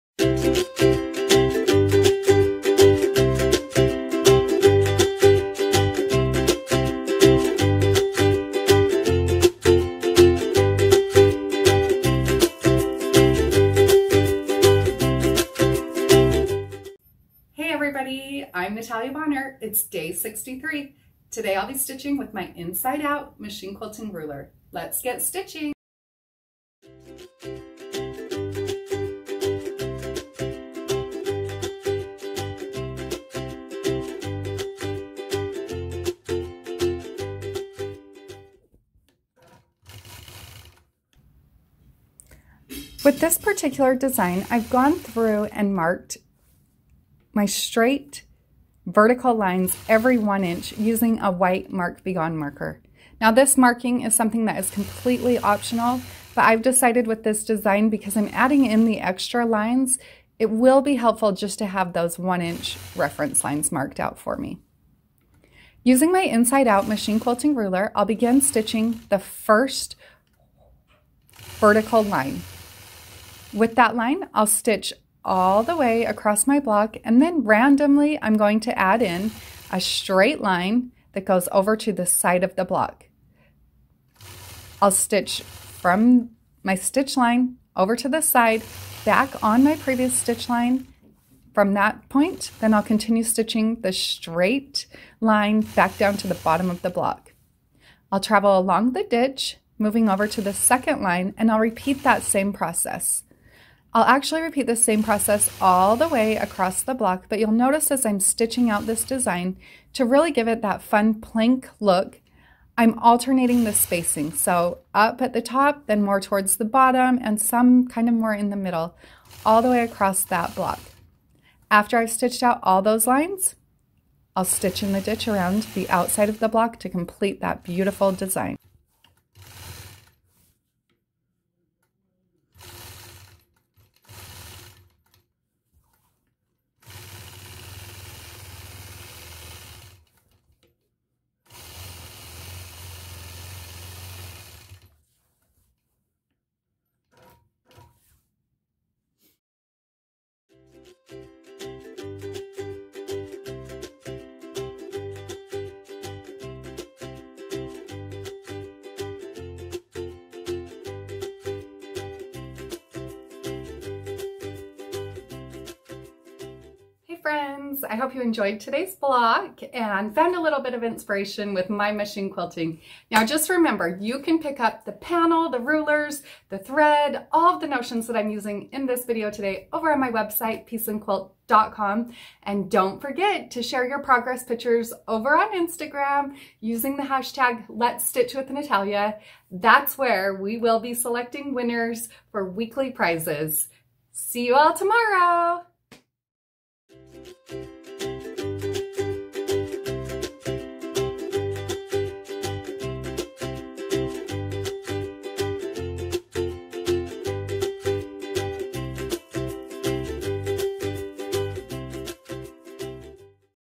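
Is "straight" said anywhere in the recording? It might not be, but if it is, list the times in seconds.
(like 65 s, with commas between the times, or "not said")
47 s, 79 s, 93 s.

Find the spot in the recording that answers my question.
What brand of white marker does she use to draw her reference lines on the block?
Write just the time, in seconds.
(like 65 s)
51 s.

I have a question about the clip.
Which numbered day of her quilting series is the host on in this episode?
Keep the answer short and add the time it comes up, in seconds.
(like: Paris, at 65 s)
63, at 20 s.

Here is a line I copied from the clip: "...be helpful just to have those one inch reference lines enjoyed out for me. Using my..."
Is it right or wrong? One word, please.
wrong.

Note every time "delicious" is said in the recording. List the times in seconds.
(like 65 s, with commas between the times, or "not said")
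not said.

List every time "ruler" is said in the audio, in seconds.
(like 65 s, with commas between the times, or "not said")
24 s, 67 s, 175 s.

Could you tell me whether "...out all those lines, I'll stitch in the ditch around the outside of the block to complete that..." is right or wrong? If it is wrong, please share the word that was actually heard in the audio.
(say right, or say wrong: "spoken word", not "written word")
right.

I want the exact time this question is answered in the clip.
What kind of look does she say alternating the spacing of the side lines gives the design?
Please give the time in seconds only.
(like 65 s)
111 s.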